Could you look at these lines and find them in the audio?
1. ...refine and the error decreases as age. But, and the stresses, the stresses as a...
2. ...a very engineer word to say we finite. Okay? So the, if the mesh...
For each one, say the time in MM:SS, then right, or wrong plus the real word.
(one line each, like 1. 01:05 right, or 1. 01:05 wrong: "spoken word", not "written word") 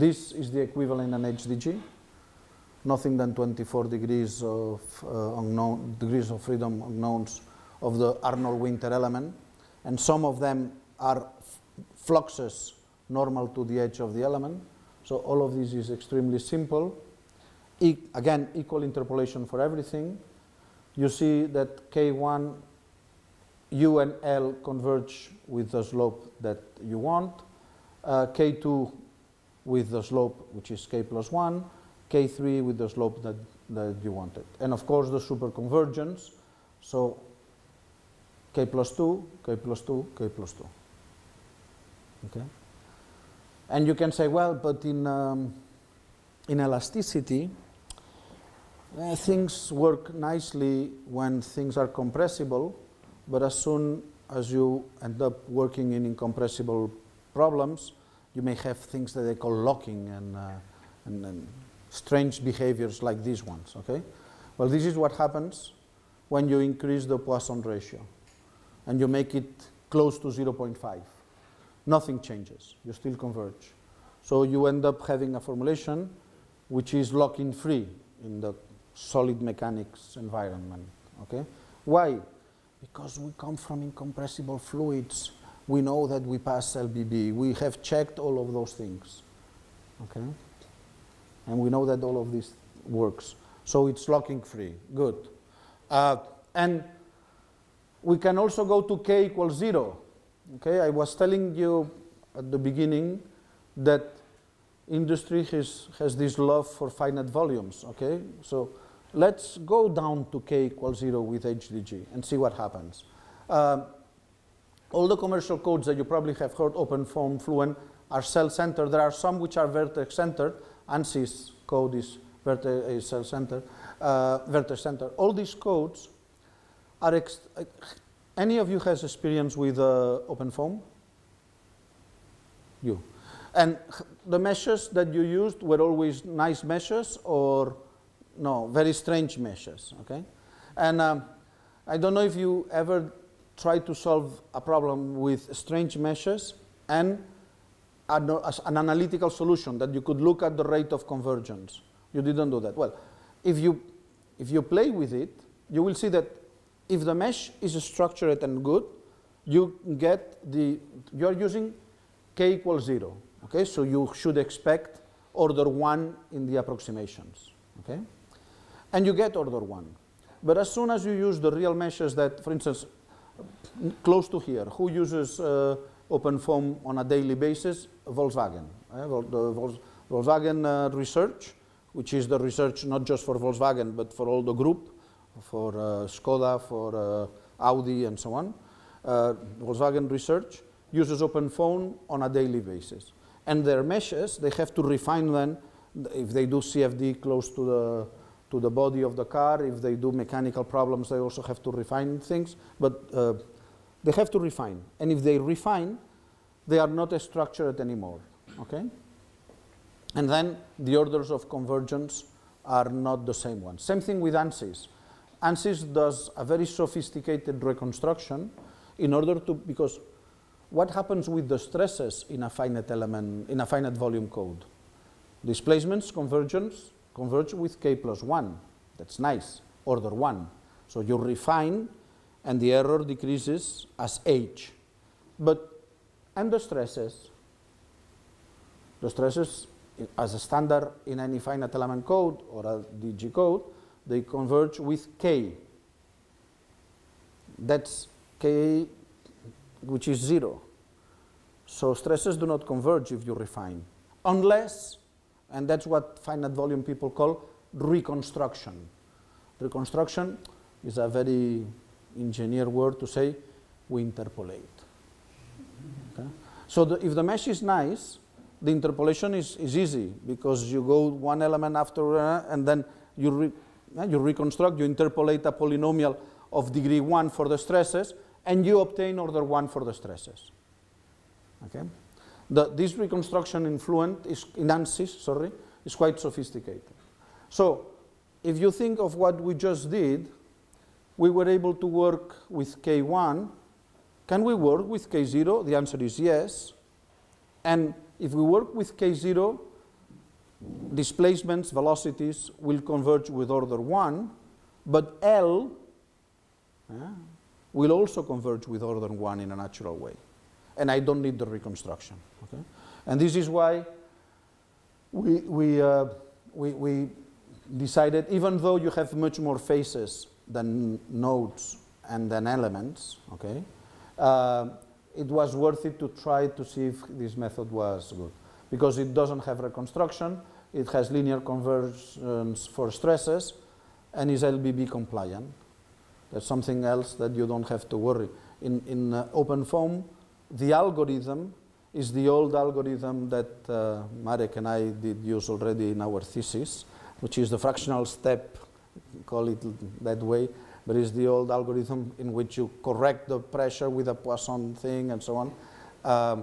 1. 03:51 right
2. 04:20 wrong: "interpolate", not "finite".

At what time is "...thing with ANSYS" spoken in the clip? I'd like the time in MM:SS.
03:33.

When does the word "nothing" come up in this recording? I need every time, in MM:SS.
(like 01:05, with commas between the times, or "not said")
00:02, 01:11.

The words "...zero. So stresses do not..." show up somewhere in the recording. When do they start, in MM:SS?
04:10.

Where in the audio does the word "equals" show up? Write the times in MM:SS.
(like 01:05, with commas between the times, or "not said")
00:18, 01:39, 01:50, 02:42.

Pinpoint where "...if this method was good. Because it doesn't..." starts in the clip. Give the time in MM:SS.
05:26.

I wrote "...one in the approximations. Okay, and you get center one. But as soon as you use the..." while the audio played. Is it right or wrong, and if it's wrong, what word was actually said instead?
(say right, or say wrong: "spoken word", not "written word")
wrong: "order", not "center".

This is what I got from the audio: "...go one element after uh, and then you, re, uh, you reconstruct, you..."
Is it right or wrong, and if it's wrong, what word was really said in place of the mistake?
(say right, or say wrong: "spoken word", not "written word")
right.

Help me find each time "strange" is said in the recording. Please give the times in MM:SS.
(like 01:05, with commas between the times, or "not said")
01:01, 02:18, 02:25.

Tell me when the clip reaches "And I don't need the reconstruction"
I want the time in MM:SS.
05:10.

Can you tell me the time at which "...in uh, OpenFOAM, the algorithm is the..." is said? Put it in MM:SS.
05:38.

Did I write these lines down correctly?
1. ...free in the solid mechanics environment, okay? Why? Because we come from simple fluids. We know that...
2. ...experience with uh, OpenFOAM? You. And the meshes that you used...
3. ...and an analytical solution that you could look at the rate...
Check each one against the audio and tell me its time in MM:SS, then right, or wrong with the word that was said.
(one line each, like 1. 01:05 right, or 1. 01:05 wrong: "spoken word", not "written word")
1. 01:17 wrong: "incompressible", not "simple"
2. 02:09 right
3. 02:26 right.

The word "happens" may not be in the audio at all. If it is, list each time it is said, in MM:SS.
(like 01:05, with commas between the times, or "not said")
01:05, 01:52, 03:40.